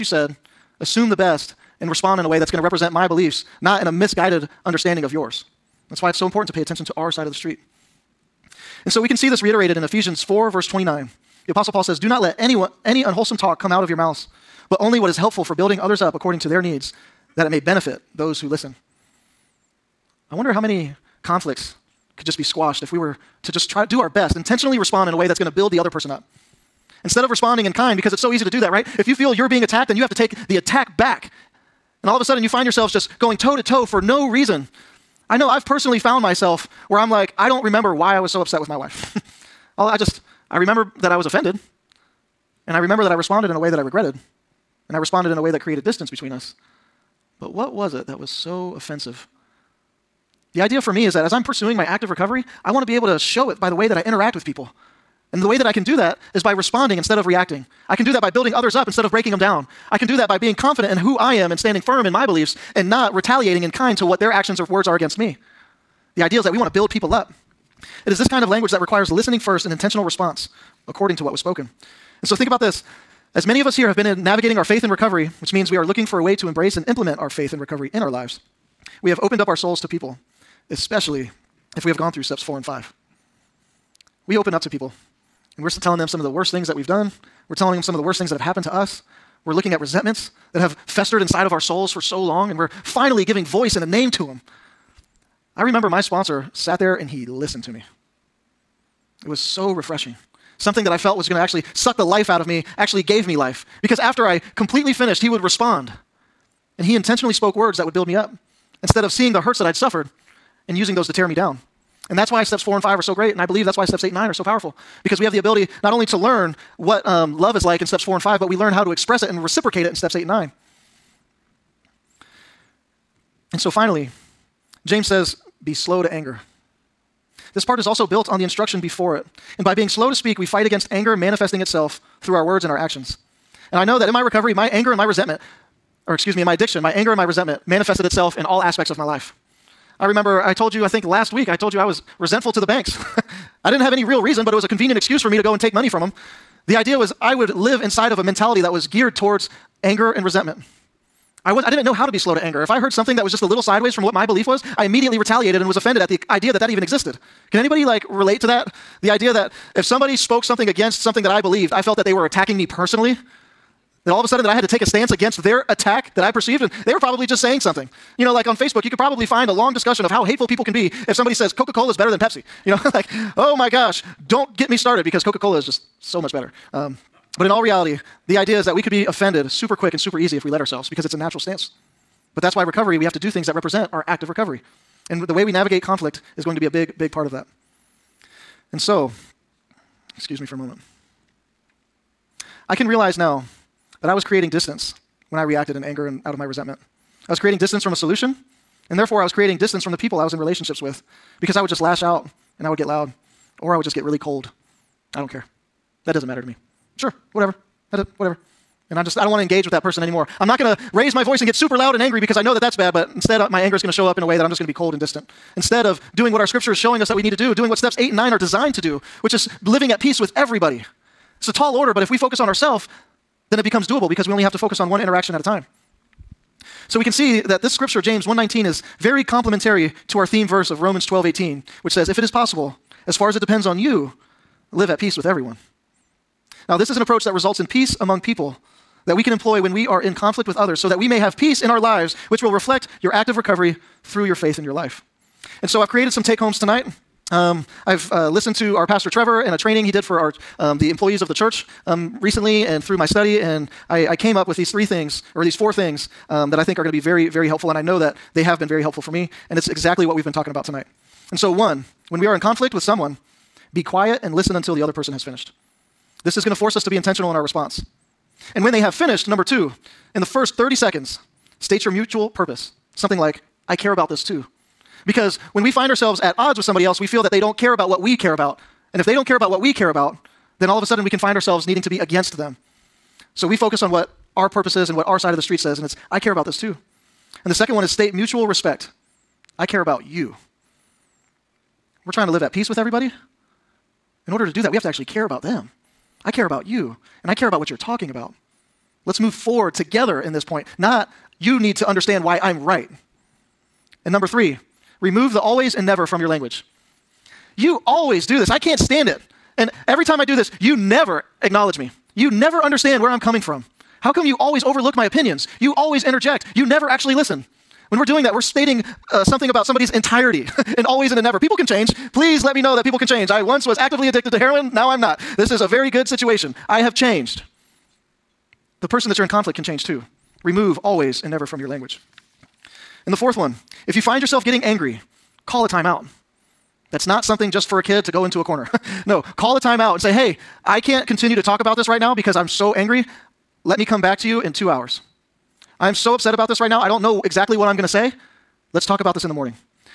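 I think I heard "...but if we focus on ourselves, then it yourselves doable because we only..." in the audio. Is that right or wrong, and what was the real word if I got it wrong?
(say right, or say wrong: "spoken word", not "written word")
wrong: "becomes", not "yourselves".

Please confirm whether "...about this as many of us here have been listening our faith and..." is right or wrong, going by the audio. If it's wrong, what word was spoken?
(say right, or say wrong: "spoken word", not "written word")
wrong: "navigating", not "listening".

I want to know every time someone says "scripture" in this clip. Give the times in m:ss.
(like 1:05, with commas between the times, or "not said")
3:36, 3:47.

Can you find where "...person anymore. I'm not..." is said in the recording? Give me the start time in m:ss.
3:29.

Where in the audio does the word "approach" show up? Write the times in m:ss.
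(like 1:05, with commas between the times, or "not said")
3:57.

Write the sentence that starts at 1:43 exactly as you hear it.
Because after I completely finished, he would respond.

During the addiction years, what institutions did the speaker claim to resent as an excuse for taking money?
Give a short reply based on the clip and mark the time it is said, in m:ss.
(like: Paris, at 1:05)
The banks, at 2:22.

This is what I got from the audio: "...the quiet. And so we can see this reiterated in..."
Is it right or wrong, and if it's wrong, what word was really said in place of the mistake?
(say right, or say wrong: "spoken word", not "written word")
wrong: "street", not "quiet".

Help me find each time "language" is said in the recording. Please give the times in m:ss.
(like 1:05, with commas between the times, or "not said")
1:08, 5:06, 5:31.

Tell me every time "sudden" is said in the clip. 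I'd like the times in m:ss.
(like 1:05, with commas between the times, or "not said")
0:32, 2:44, 4:40.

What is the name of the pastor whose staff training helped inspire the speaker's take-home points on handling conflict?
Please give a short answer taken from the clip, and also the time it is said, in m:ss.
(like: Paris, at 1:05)
Trevor, at 4:09.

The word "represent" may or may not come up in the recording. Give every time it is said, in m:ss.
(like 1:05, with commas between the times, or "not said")
0:02, 3:03.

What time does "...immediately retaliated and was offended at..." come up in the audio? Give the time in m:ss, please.
2:34.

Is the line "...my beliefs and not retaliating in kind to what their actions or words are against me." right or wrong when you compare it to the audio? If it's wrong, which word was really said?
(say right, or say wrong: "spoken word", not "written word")
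right.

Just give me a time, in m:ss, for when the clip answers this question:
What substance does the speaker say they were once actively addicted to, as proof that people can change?
5:24.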